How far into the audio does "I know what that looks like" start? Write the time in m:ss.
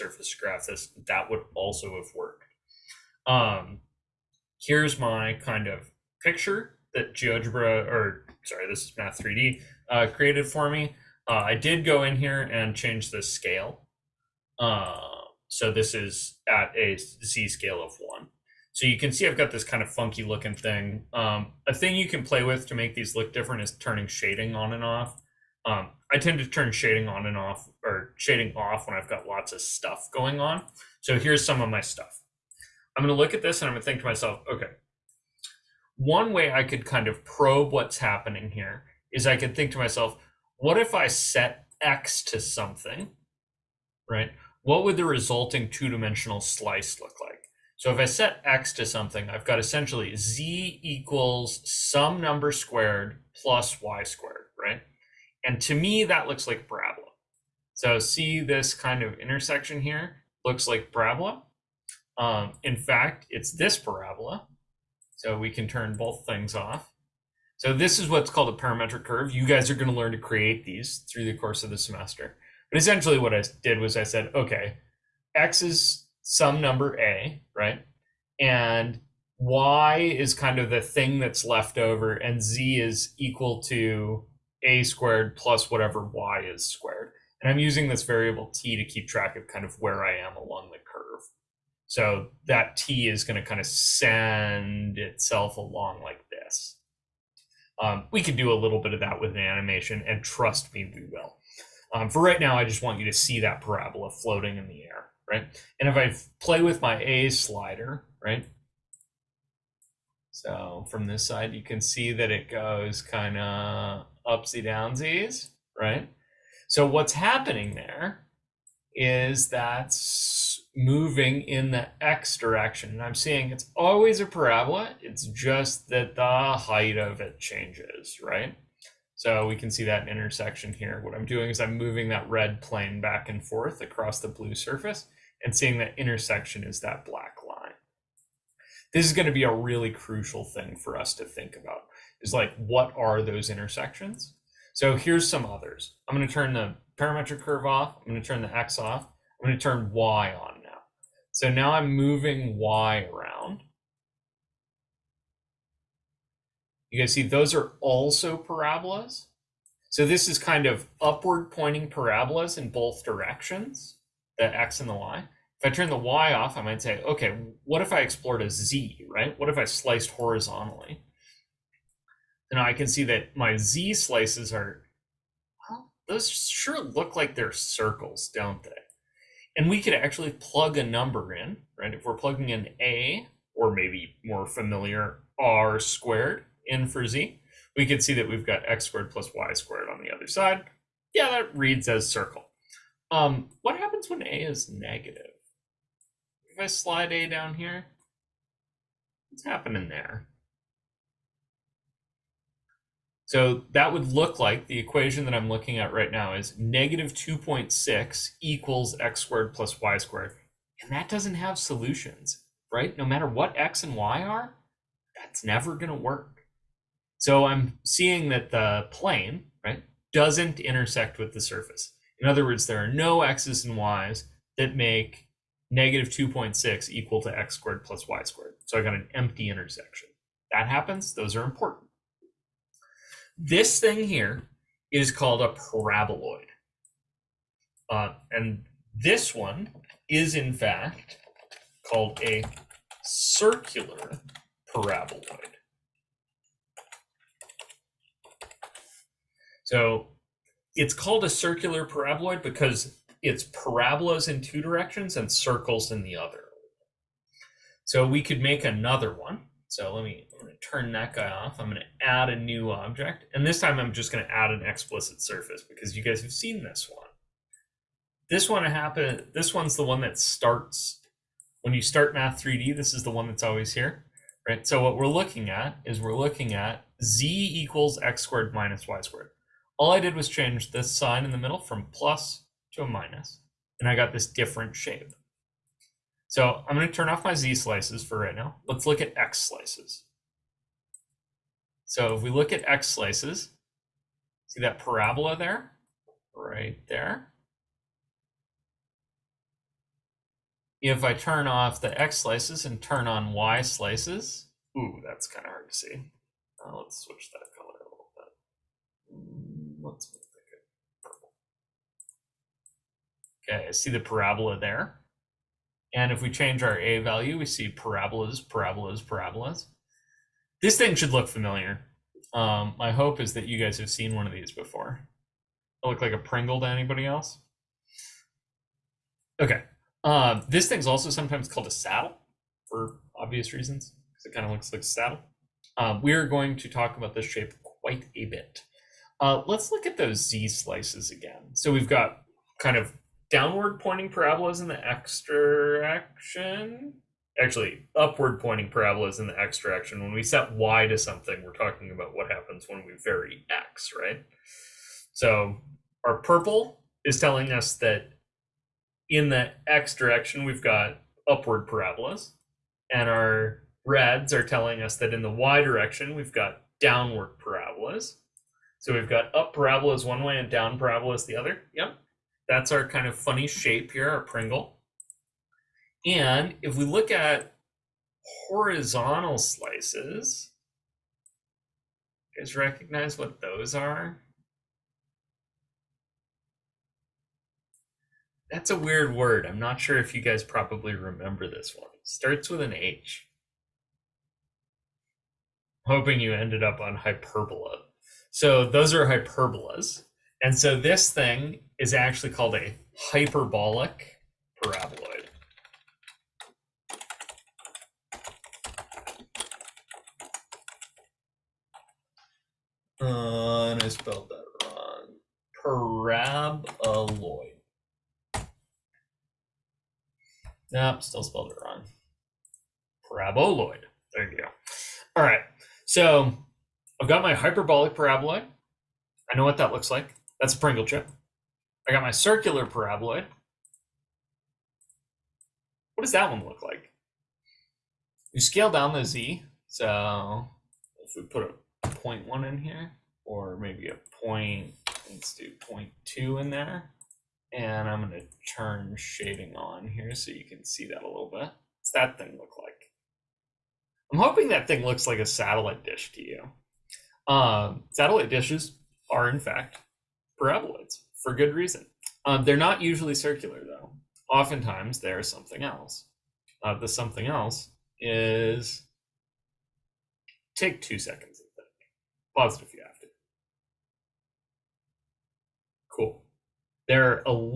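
7:09.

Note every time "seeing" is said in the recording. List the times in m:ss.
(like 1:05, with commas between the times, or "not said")
2:03, 2:15, 3:37.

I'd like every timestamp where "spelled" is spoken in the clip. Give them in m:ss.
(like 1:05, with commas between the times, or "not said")
6:53, 7:01.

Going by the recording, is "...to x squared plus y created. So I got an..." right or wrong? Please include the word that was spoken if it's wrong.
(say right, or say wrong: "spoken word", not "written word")
wrong: "squared", not "created".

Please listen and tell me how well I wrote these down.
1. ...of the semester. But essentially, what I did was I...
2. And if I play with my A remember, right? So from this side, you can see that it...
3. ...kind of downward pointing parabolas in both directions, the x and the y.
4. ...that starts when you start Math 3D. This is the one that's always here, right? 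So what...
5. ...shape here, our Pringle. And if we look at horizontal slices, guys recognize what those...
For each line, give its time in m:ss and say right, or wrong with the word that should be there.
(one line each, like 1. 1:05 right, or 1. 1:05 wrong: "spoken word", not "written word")
1. 1:11 right
2. 1:45 wrong: "slider", not "remember"
3. 2:40 wrong: "upward", not "downward"
4. 4:30 right
5. 6:13 right.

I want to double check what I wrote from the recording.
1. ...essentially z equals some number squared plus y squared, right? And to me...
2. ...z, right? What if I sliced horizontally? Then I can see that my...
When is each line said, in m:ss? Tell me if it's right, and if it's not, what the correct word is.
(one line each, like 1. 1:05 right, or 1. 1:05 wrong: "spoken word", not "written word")
1. 0:49 right
2. 2:48 right.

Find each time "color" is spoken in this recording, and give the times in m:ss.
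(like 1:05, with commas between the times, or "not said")
5:07.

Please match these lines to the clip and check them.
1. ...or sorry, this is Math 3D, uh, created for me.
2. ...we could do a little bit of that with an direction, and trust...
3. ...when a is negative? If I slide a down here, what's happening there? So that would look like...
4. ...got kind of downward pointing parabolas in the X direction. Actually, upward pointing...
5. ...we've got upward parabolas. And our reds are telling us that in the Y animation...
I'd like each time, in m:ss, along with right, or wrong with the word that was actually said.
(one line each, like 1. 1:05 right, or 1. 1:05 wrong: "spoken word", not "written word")
1. 0:07 right
2. 1:38 wrong: "animation", not "direction"
3. 3:14 right
4. 5:41 right
5. 6:00 wrong: "direction", not "animation".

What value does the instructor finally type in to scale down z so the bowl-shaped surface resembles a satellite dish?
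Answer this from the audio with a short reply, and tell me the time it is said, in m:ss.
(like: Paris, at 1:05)
0.2, at 7:24.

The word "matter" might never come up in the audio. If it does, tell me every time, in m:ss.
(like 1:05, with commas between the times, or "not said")
3:33.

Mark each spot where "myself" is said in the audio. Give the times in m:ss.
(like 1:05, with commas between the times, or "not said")
0:34, 0:39.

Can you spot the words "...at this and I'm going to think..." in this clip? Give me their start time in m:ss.
0:33.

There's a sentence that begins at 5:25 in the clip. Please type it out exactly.
look like a Pringle to anybody else?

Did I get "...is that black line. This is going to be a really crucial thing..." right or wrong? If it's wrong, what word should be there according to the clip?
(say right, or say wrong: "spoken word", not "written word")
right.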